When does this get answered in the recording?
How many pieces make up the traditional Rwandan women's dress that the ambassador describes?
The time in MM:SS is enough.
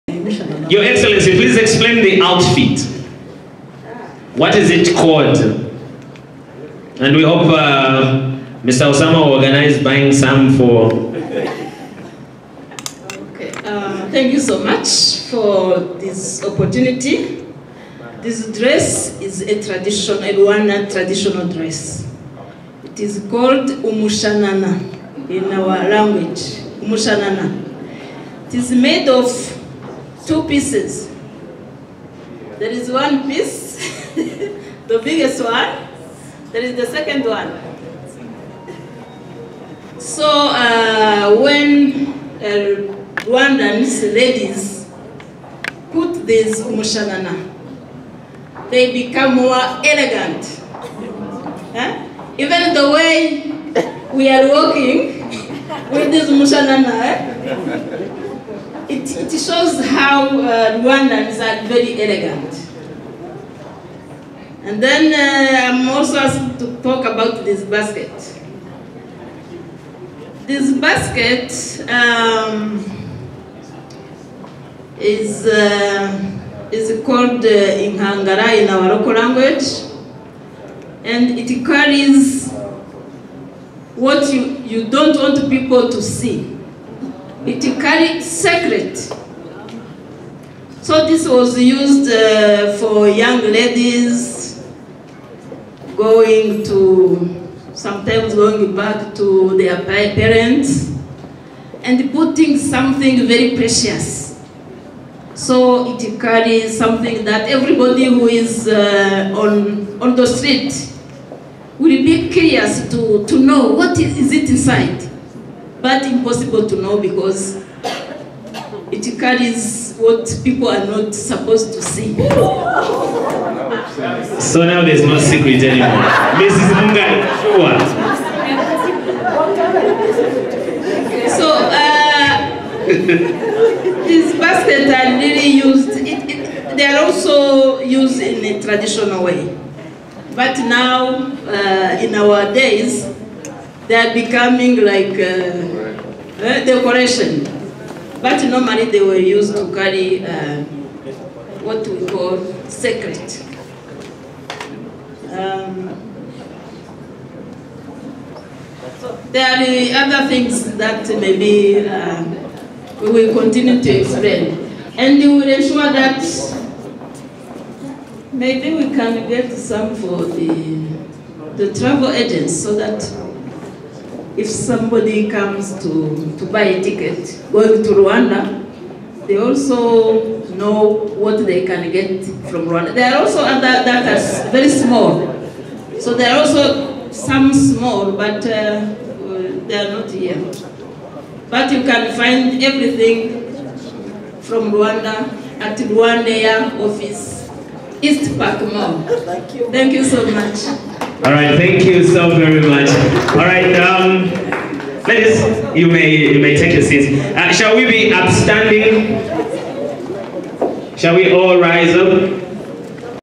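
00:30.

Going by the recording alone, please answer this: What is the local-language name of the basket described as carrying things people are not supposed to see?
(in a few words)
inkangara.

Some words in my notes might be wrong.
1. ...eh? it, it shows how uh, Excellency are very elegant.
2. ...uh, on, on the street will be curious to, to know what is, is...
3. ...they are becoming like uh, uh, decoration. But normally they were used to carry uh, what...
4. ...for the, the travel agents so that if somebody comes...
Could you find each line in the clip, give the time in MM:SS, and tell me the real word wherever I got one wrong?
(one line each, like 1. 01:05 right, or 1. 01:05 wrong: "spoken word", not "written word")
1. 00:56 wrong: "Rwandans", not "Excellency"
2. 01:48 right
3. 02:23 right
4. 02:49 right.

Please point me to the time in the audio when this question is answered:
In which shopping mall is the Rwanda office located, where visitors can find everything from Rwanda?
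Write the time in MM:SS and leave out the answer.
03:18.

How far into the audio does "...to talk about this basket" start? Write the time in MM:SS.
01:06.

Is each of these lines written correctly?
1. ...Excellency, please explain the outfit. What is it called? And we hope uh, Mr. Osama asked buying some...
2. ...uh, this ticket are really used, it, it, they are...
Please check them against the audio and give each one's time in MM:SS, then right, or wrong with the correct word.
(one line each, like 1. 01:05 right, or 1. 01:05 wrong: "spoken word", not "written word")
1. 00:00 wrong: "organized", not "asked"
2. 02:11 wrong: "basket", not "ticket".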